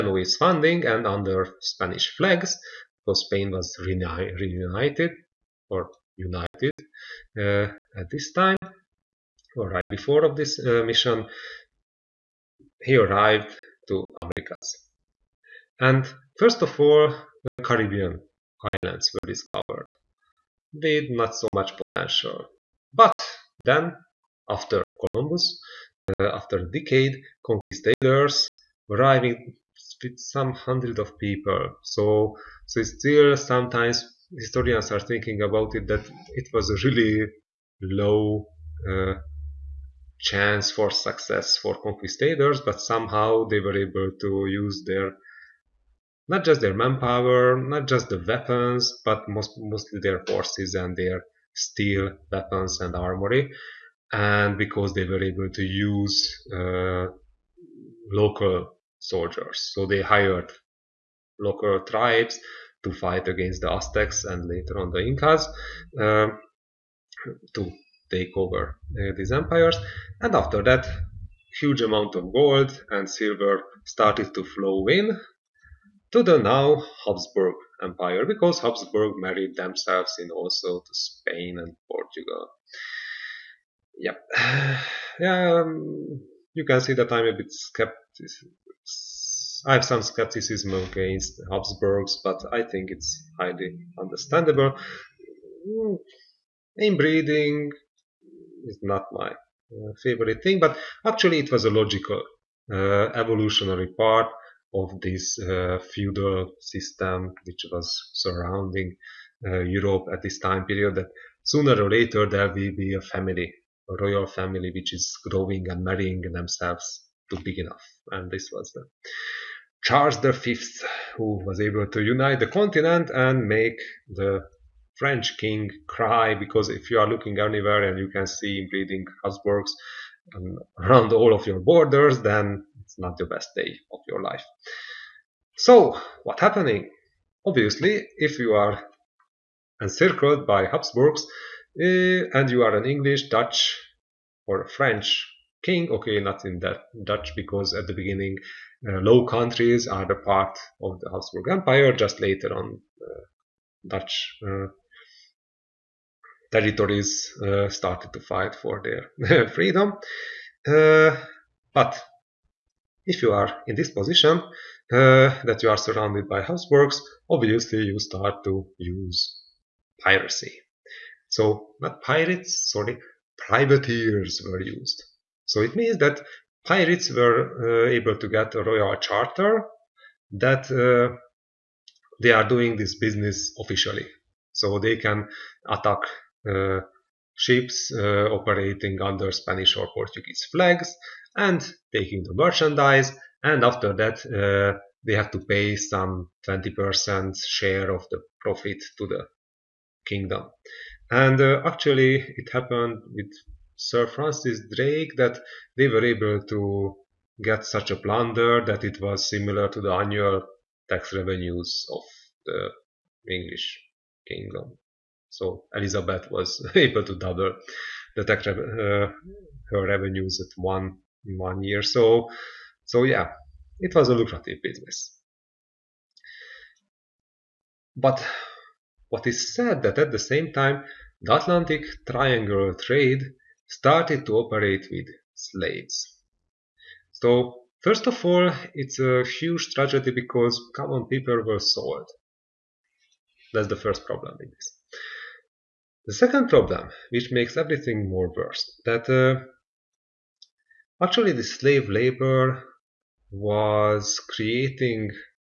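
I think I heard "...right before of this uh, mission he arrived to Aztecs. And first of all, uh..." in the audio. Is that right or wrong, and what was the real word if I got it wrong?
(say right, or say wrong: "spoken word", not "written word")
wrong: "Americas", not "Aztecs".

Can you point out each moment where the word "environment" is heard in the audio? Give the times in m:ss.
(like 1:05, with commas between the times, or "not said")
not said.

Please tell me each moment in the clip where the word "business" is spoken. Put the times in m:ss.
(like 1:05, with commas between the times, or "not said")
3:02, 3:44.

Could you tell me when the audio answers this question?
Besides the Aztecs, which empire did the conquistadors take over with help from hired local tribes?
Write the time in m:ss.
1:05.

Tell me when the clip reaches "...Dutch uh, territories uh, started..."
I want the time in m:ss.
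2:33.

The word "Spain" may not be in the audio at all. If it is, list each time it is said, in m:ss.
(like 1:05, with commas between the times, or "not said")
0:03, 1:20.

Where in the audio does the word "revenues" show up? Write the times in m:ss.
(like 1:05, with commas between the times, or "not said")
3:31, 3:39.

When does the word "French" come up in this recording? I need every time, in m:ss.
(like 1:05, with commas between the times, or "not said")
2:04, 2:24.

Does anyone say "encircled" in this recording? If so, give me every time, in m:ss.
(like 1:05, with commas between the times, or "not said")
2:19.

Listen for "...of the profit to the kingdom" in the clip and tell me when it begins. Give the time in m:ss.
3:17.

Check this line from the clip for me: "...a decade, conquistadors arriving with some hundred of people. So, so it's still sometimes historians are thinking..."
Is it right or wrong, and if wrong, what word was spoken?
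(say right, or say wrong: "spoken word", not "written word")
right.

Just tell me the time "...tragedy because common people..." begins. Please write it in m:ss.
3:59.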